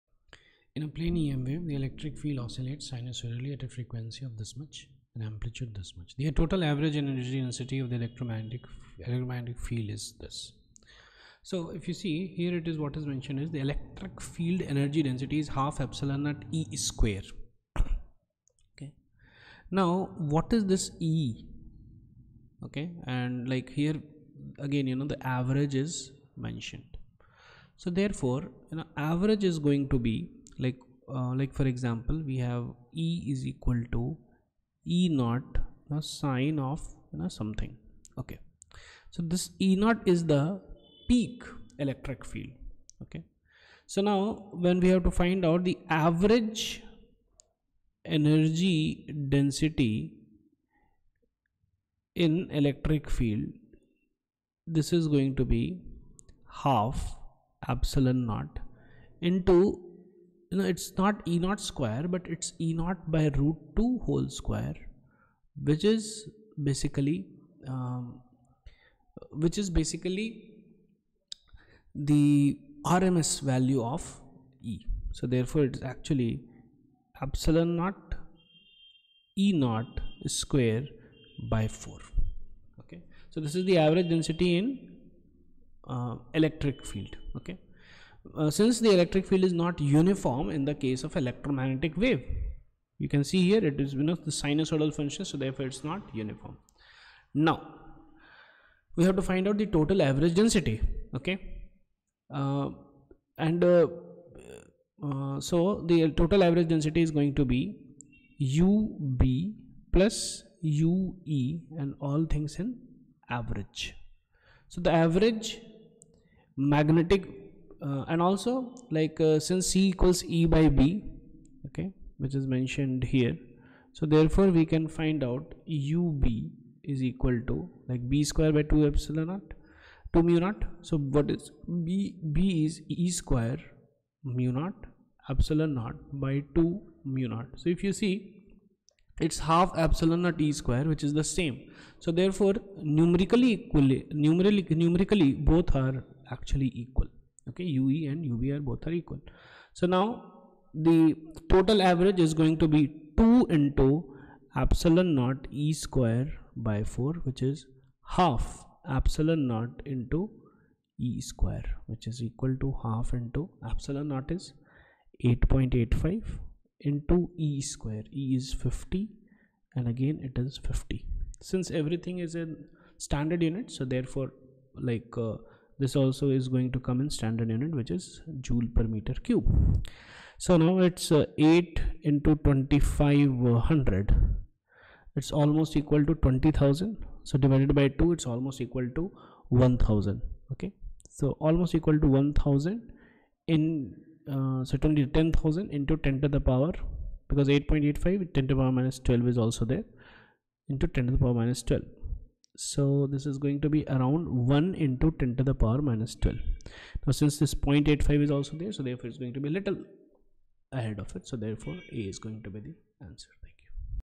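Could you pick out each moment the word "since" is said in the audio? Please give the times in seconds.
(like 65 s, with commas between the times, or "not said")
88 s, 119 s, 171 s, 207 s.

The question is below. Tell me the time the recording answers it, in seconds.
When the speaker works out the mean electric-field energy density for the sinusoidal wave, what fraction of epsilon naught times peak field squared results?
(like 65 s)
77 s.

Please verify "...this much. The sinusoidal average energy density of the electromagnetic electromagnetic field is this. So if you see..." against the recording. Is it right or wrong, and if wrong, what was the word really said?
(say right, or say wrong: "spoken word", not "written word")
wrong: "total", not "sinusoidal".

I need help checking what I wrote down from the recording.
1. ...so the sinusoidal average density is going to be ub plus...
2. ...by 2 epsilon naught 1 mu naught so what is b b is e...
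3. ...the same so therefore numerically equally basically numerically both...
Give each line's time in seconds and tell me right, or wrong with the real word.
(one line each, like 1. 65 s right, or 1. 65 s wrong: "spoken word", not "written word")
1. 105 s wrong: "total", not "sinusoidal"
2. 128 s wrong: "2", not "1"
3. 141 s wrong: "numerically", not "basically".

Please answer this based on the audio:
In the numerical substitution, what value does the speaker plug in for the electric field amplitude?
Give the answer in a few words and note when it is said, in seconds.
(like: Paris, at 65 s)
50, at 168 s.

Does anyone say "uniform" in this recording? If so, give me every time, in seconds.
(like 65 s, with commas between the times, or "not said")
89 s, 96 s.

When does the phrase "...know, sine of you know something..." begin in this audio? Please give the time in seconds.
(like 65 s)
35 s.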